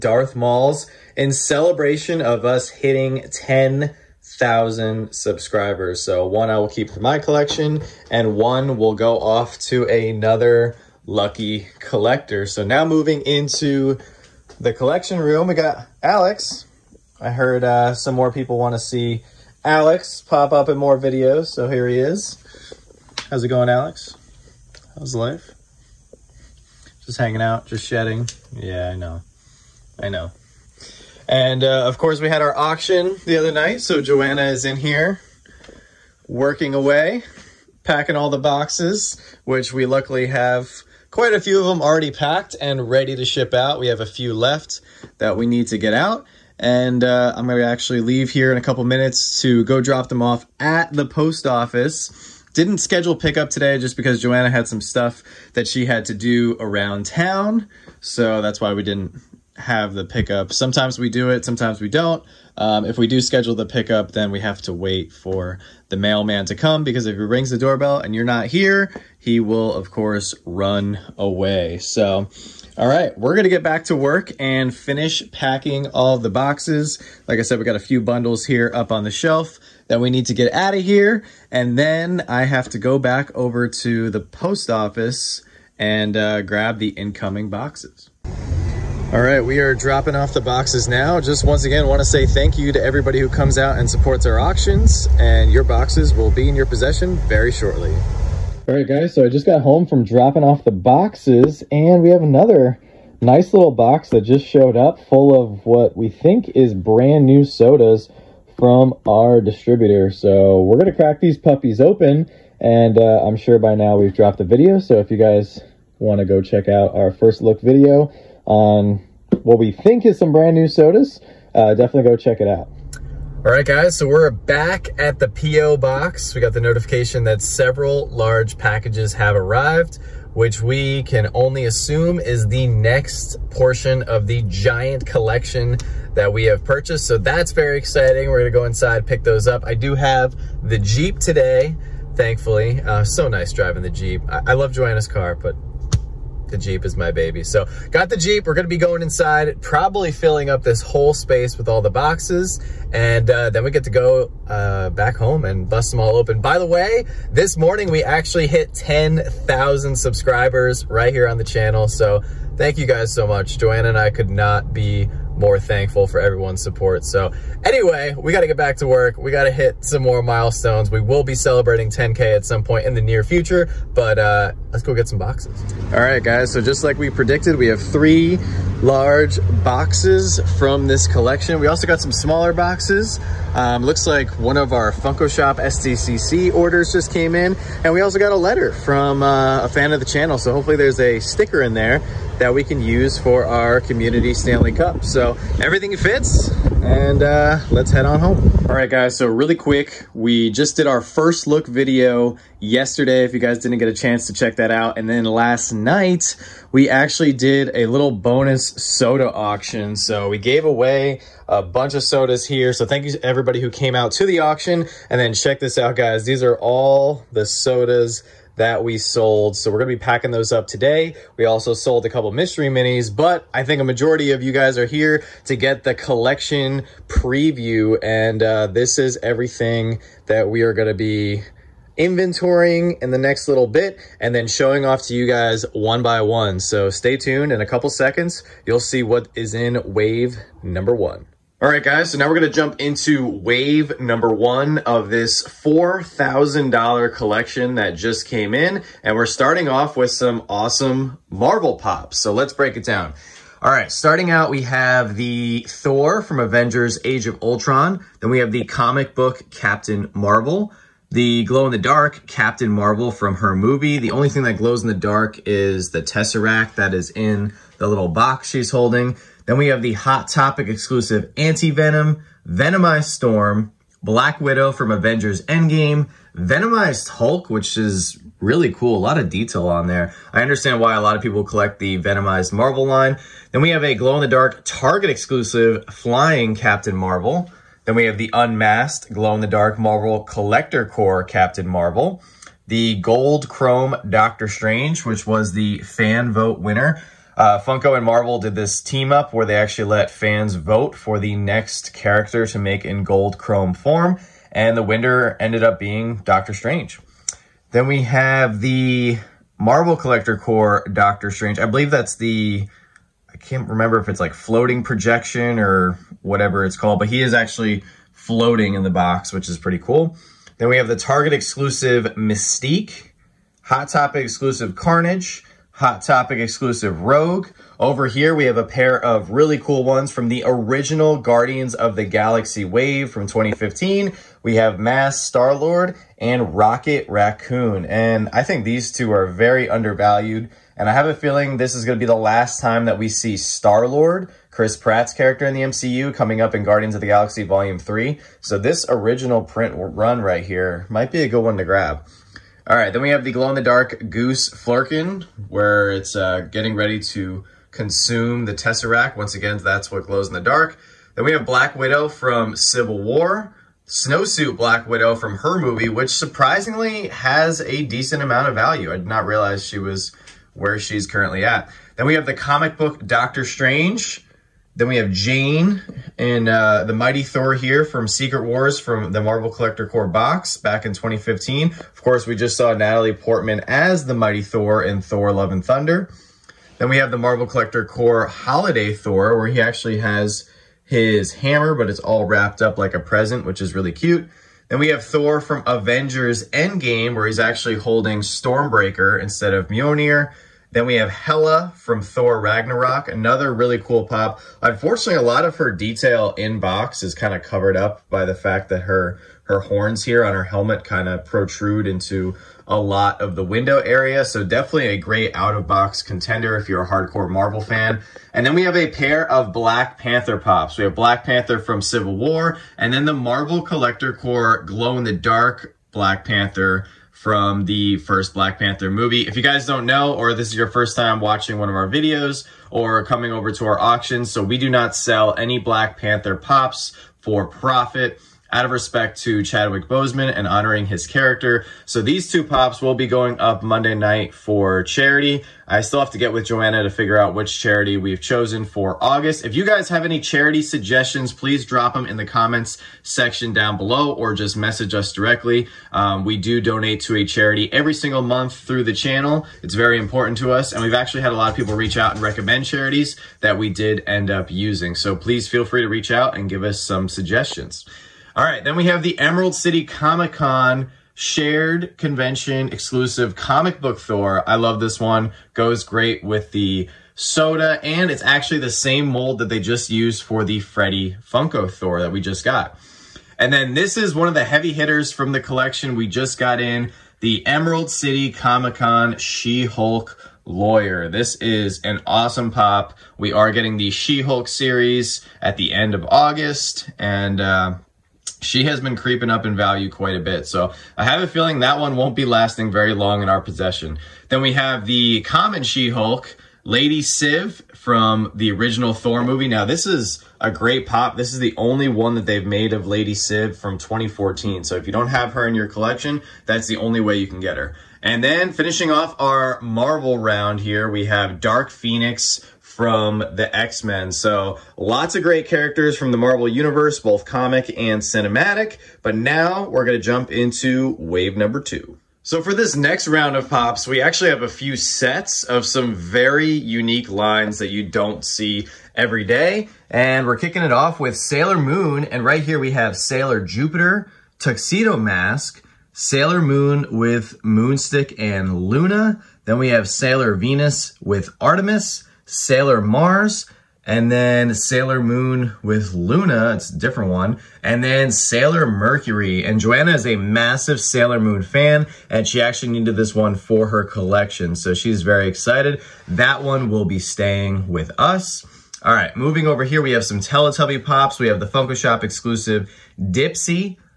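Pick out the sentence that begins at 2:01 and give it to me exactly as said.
Uh, definitely go check it out.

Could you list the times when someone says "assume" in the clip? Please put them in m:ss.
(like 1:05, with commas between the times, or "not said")
2:11.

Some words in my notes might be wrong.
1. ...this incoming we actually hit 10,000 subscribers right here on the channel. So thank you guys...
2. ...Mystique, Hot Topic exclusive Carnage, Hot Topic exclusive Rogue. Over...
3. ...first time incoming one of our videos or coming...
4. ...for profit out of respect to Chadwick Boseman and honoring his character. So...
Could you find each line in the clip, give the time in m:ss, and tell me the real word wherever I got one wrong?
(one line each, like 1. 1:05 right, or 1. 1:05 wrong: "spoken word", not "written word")
1. 2:37 wrong: "morning", not "incoming"
2. 5:22 right
3. 7:10 wrong: "watching", not "incoming"
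4. 7:17 right.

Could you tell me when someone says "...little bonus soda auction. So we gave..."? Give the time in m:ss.
3:27.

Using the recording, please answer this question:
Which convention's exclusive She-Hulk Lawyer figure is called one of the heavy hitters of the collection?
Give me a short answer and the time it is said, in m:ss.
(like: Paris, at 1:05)
Emerald City Comic-Con, at 8:07.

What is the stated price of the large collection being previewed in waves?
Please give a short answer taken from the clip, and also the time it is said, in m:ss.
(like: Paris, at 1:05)
$4,000, at 4:05.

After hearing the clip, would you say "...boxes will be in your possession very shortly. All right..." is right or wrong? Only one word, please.
right.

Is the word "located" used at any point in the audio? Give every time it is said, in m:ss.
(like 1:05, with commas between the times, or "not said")
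not said.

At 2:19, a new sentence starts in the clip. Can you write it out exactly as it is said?
I do have the Jeep today, thankfully.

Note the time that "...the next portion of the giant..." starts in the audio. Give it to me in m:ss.
2:12.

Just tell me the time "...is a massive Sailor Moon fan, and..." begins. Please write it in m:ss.
9:19.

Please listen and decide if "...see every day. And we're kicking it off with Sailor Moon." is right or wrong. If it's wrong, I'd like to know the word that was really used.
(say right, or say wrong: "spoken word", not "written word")
right.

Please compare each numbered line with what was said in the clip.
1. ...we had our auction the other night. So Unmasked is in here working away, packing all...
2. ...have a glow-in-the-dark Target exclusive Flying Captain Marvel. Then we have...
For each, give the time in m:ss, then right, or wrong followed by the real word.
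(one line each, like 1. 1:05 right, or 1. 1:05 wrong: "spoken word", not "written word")
1. 0:32 wrong: "Joanna", not "Unmasked"
2. 4:43 right.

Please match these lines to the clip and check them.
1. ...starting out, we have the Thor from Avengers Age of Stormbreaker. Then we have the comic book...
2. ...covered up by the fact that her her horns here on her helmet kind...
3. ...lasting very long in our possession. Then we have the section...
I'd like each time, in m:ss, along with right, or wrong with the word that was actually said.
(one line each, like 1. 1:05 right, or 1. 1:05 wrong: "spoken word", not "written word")
1. 4:13 wrong: "Ultron", not "Stormbreaker"
2. 6:47 right
3. 8:22 wrong: "common", not "section".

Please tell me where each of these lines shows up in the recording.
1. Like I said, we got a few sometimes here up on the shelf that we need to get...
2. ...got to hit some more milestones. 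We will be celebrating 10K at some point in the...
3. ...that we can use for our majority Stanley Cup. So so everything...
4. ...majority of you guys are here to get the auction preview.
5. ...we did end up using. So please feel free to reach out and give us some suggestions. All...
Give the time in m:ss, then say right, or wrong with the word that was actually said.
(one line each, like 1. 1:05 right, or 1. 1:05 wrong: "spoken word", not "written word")
1. 1:17 wrong: "bundles", not "sometimes"
2. 2:49 right
3. 3:12 wrong: "community", not "majority"
4. 3:43 wrong: "collection", not "auction"
5. 7:43 right.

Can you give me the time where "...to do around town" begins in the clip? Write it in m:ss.
0:56.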